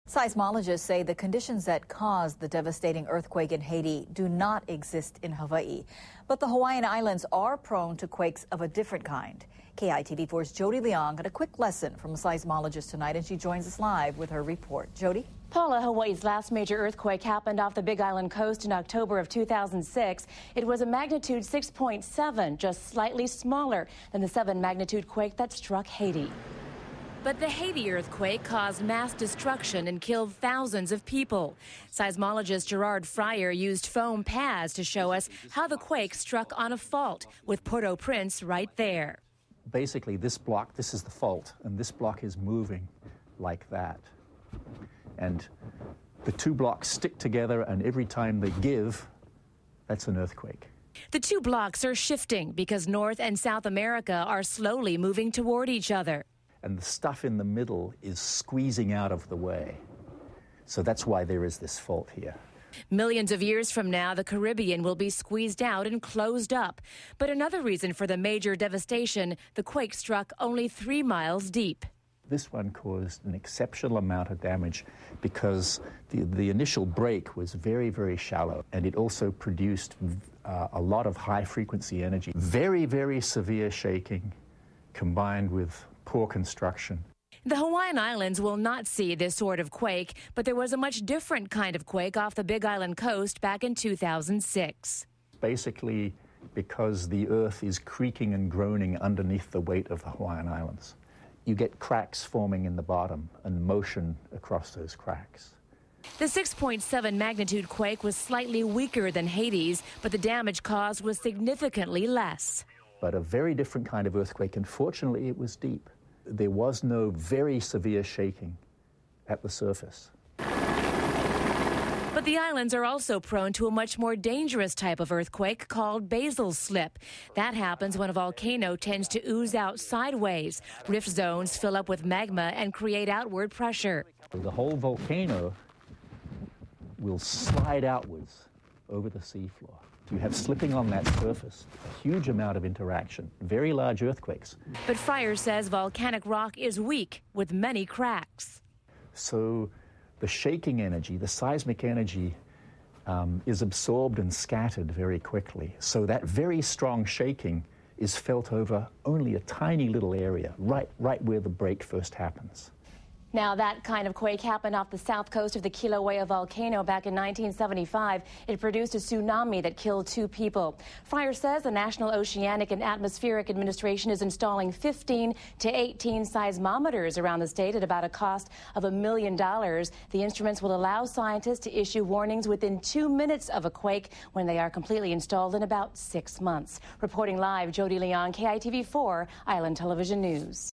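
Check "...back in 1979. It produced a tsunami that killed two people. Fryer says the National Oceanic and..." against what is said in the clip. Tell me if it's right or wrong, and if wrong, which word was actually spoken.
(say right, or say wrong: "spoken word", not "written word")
wrong: "1975", not "1979".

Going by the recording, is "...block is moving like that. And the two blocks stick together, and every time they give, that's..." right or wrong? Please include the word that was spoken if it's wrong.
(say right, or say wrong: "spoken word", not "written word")
right.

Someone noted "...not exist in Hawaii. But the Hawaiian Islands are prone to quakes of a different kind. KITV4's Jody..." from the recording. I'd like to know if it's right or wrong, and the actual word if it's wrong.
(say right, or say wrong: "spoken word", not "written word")
right.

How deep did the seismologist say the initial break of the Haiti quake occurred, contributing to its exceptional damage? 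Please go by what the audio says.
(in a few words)
3 miles.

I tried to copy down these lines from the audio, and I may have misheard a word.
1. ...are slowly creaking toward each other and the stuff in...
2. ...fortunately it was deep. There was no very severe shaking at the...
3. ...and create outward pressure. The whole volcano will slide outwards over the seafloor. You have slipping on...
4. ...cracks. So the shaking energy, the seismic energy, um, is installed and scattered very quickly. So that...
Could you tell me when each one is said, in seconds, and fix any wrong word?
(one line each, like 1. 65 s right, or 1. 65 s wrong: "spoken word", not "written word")
1. 54 s wrong: "moving", not "creaking"
2. 114 s right
3. 132 s right
4. 147 s wrong: "absorbed", not "installed".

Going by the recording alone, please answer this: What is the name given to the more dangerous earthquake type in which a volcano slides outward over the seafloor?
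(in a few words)
basal slip.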